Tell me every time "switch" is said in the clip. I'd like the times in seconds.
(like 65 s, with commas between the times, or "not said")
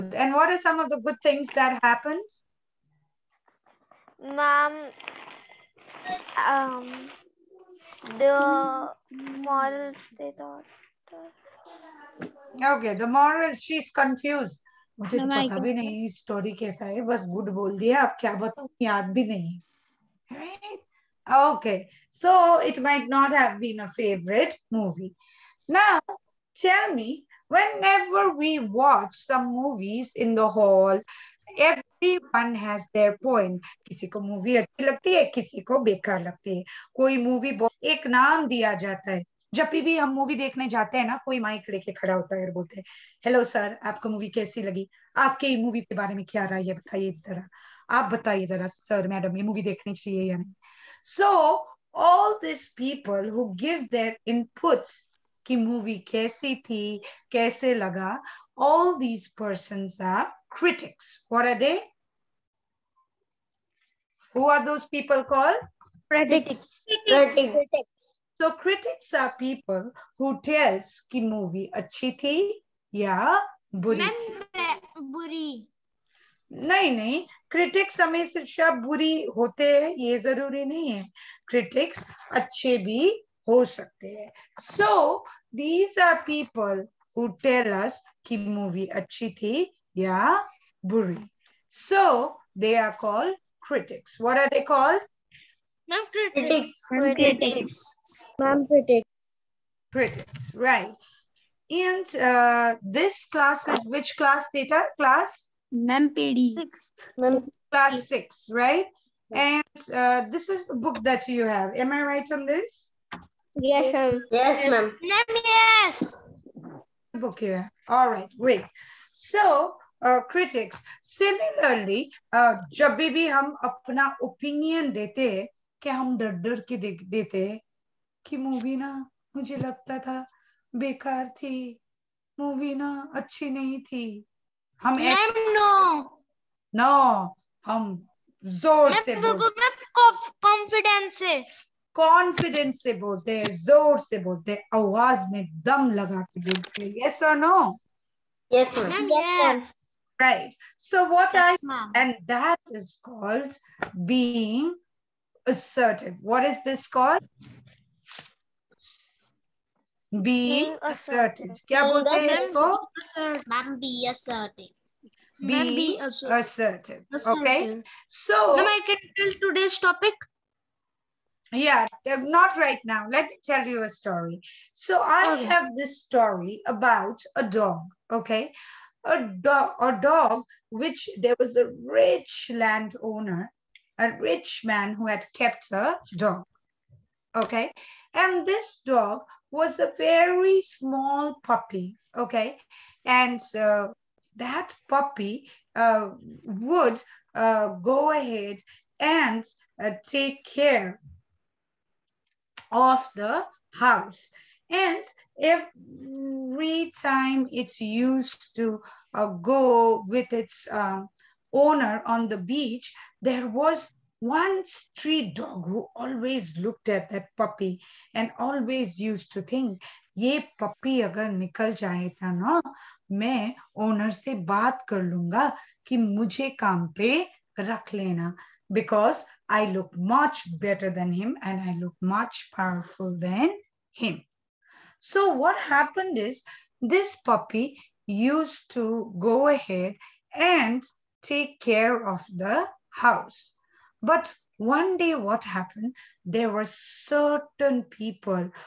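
not said.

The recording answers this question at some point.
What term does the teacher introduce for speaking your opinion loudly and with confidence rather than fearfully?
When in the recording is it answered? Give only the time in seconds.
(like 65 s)
160 s.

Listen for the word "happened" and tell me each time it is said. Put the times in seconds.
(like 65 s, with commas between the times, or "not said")
1 s, 235 s, 245 s.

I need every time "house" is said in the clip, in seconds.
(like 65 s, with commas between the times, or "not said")
203 s, 242 s.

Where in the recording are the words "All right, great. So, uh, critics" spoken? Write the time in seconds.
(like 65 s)
117 s.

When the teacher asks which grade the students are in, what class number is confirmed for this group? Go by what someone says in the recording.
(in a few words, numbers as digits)
6.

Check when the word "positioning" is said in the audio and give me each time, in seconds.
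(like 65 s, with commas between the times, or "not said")
not said.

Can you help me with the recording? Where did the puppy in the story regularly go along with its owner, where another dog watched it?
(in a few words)
The beach.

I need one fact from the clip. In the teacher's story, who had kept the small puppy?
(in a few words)
Rich landowner.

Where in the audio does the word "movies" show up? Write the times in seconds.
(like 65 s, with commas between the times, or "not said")
29 s.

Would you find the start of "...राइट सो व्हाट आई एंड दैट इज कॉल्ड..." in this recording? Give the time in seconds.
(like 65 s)
150 s.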